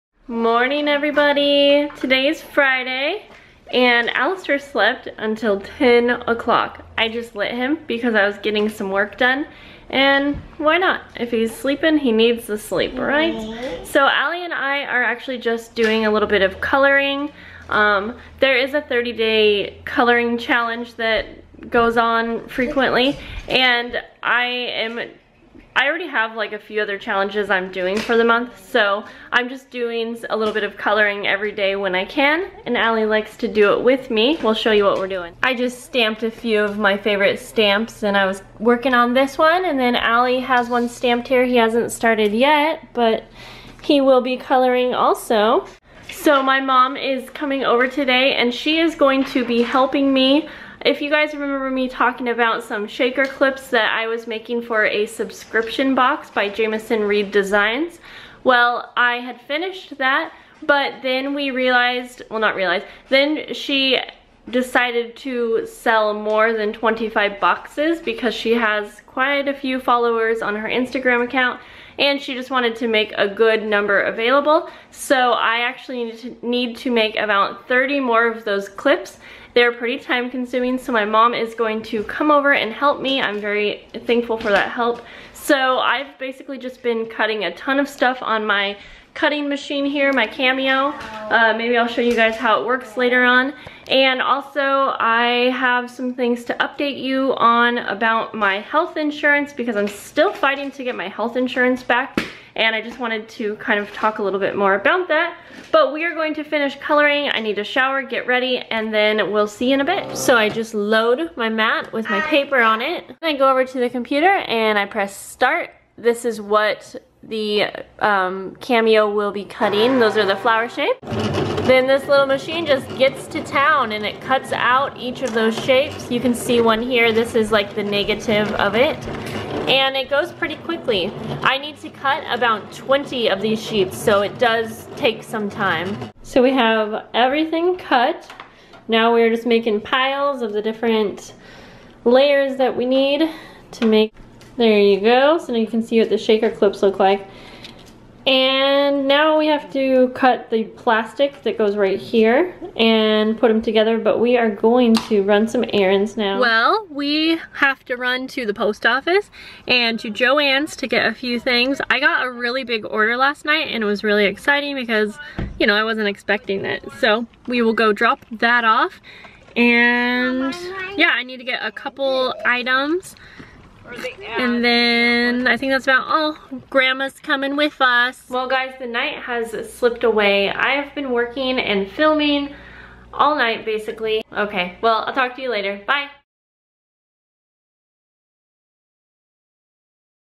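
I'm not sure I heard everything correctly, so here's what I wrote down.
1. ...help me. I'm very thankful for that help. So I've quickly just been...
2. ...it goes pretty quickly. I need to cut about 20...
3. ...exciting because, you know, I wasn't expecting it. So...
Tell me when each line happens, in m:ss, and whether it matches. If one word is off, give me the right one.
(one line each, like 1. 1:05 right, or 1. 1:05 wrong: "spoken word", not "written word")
1. 1:22 wrong: "basically", not "quickly"
2. 2:09 right
3. 2:44 right.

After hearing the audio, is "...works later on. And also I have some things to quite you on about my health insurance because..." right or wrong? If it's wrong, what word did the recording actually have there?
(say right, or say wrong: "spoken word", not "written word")
wrong: "update", not "quite".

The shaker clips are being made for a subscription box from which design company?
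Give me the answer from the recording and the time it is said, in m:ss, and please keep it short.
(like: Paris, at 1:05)
Jamison Reid Designs, at 0:56.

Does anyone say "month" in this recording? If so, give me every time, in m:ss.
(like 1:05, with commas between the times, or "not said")
0:28.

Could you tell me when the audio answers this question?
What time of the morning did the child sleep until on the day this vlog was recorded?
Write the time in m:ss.
0:05.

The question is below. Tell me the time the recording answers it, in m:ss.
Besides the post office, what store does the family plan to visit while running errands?
2:40.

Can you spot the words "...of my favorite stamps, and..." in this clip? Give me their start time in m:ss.
0:36.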